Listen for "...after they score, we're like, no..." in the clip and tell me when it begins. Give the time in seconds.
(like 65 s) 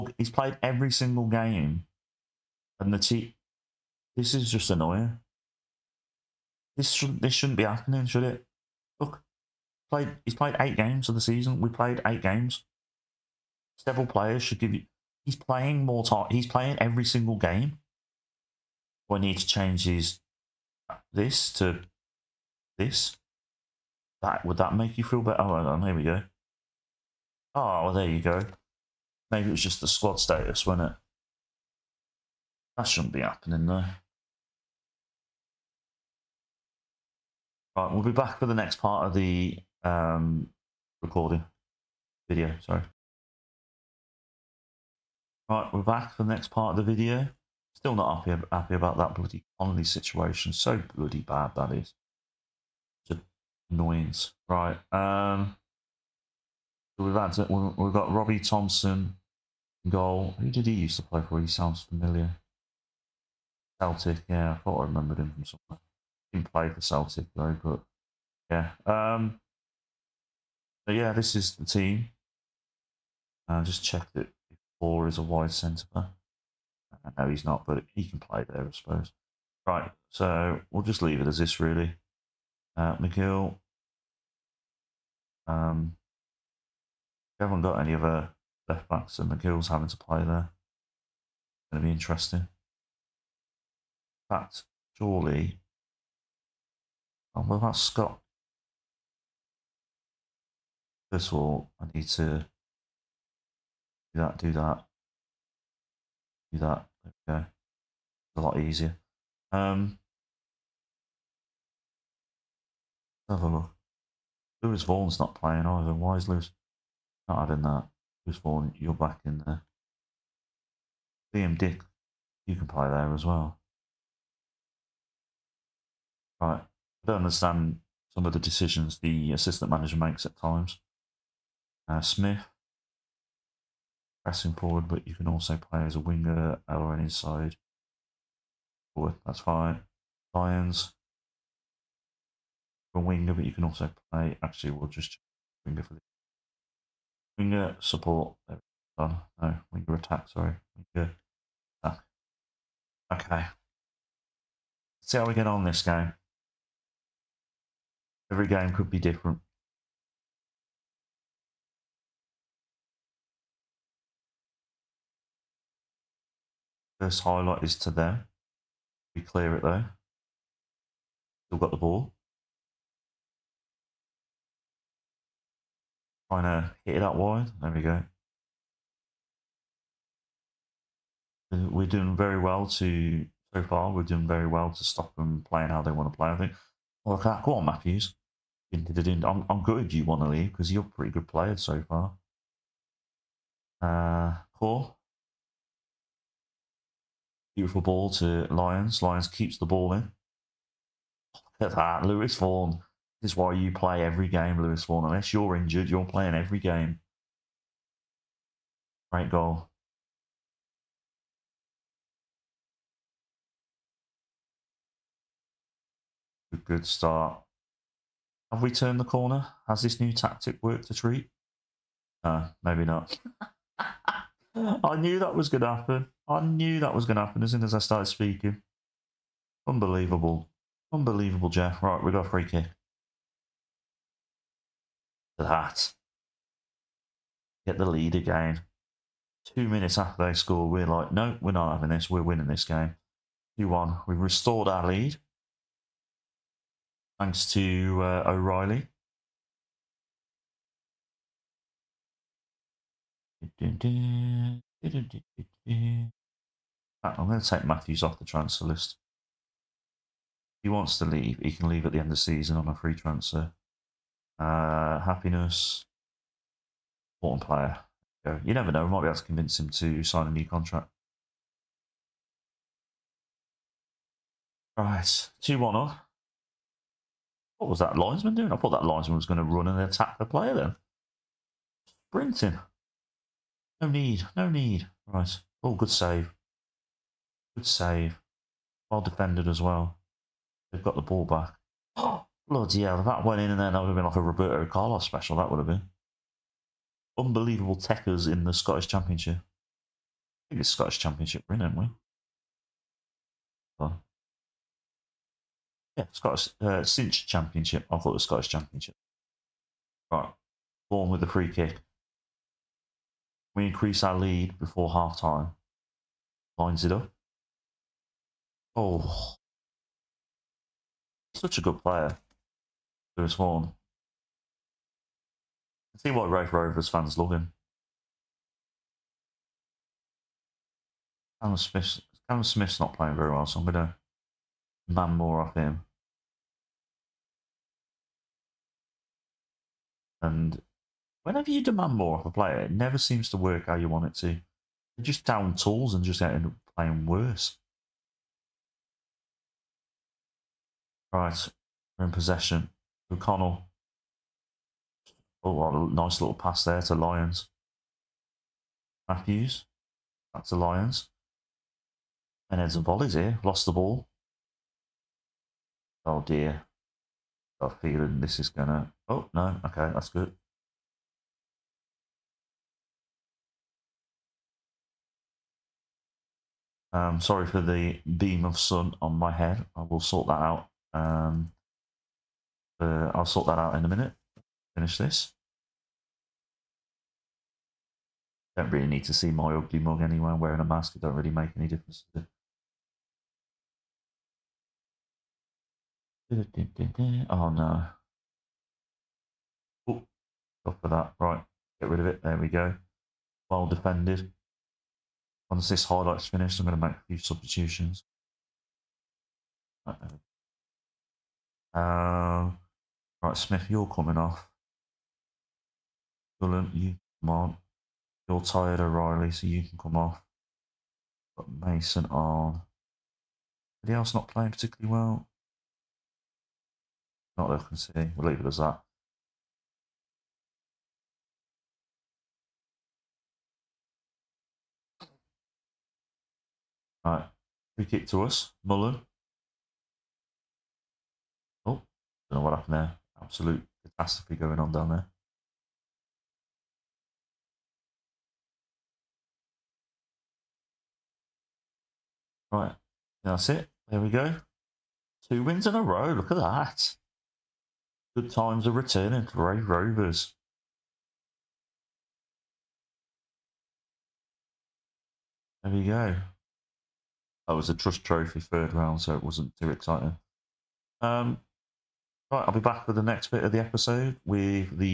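239 s.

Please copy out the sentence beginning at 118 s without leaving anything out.
Lewis Vaughan, you're back in there.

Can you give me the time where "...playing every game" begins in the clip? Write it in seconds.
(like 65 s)
206 s.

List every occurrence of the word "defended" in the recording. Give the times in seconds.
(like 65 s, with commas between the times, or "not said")
289 s, 403 s.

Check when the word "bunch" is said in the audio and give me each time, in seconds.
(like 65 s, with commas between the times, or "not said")
not said.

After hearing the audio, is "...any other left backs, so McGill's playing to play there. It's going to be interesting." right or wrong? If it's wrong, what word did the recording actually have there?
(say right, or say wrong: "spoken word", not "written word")
wrong: "having", not "playing".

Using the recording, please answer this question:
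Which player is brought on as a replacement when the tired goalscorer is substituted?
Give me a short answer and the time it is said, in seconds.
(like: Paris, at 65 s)
Mason, at 421 s.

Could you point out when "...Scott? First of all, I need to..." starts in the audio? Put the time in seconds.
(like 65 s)
97 s.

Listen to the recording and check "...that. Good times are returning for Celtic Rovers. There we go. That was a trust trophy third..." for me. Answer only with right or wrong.
wrong.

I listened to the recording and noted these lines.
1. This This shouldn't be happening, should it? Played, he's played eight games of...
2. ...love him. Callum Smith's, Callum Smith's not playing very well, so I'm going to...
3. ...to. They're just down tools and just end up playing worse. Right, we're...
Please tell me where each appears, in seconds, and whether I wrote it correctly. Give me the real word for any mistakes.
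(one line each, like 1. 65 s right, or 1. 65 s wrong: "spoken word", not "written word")
1. 6 s right
2. 327 s right
3. 344 s right.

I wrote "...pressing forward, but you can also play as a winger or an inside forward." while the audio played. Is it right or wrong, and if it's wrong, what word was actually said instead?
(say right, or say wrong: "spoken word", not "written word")
right.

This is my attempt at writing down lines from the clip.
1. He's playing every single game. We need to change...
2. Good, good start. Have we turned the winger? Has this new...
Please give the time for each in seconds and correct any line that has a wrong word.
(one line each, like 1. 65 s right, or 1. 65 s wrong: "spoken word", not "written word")
1. 16 s right
2. 216 s wrong: "corner", not "winger".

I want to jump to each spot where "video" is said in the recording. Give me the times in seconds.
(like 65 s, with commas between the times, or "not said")
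42 s, 46 s.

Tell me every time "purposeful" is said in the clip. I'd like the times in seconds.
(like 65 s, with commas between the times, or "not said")
not said.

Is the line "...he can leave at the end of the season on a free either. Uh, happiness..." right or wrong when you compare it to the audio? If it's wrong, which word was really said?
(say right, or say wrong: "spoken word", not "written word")
wrong: "transfer", not "either".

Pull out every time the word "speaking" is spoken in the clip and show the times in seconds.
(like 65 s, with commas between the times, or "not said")
228 s.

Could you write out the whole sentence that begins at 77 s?
Uh, no, he's not, but he can play there, I suppose.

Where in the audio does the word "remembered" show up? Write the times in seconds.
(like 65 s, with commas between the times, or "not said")
64 s.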